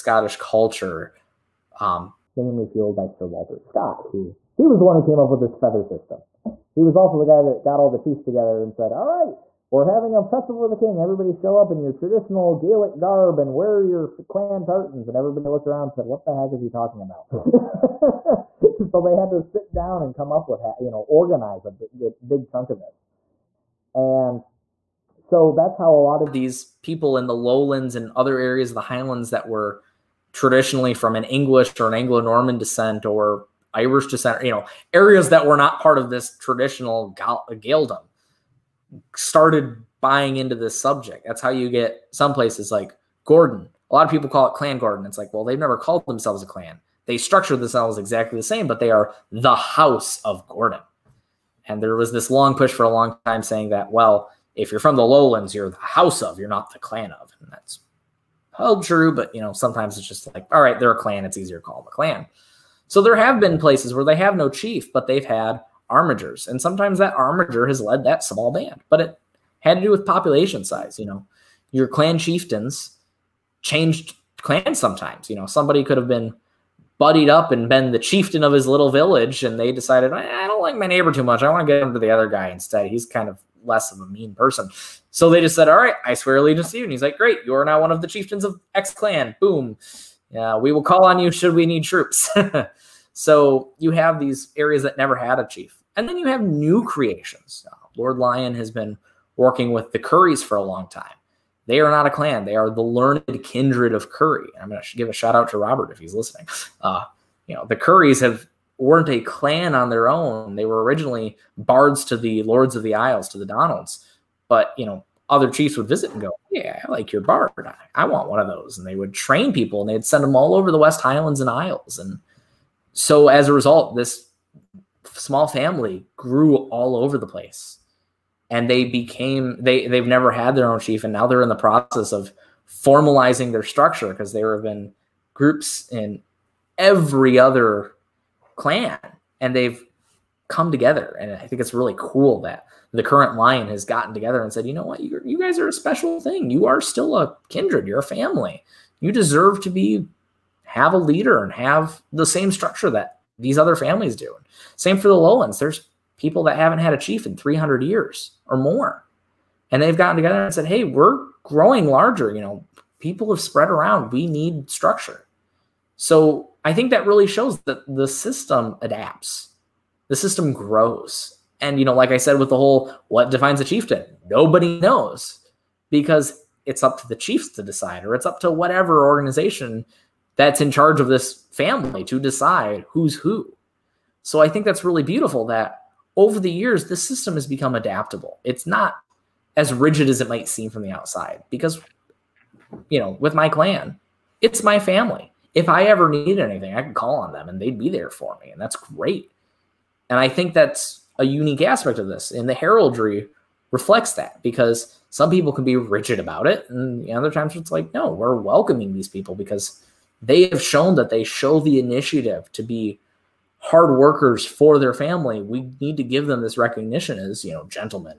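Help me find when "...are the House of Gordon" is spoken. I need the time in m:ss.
0:48.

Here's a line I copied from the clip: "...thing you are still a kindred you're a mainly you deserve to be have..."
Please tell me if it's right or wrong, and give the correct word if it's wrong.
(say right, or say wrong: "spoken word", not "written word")
wrong: "family", not "mainly".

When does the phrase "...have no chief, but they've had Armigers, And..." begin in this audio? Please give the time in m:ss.
1:04.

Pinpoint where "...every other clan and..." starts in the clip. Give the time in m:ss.
2:16.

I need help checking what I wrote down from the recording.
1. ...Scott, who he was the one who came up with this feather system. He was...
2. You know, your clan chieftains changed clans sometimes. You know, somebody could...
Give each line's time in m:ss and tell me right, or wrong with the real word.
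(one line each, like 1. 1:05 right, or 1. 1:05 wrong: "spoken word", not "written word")
1. 0:03 right
2. 1:10 right.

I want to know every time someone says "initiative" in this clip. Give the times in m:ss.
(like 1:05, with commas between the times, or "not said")
3:31.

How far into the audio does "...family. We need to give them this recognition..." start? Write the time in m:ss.
3:34.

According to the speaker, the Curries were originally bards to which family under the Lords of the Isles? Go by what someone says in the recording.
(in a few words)
the Donalds.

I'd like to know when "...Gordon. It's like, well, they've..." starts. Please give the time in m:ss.
0:44.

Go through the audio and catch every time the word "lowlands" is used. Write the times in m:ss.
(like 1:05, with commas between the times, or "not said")
0:27, 0:55, 2:35.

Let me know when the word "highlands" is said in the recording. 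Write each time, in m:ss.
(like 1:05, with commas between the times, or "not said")
0:28, 2:01.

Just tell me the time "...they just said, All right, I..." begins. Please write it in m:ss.
1:25.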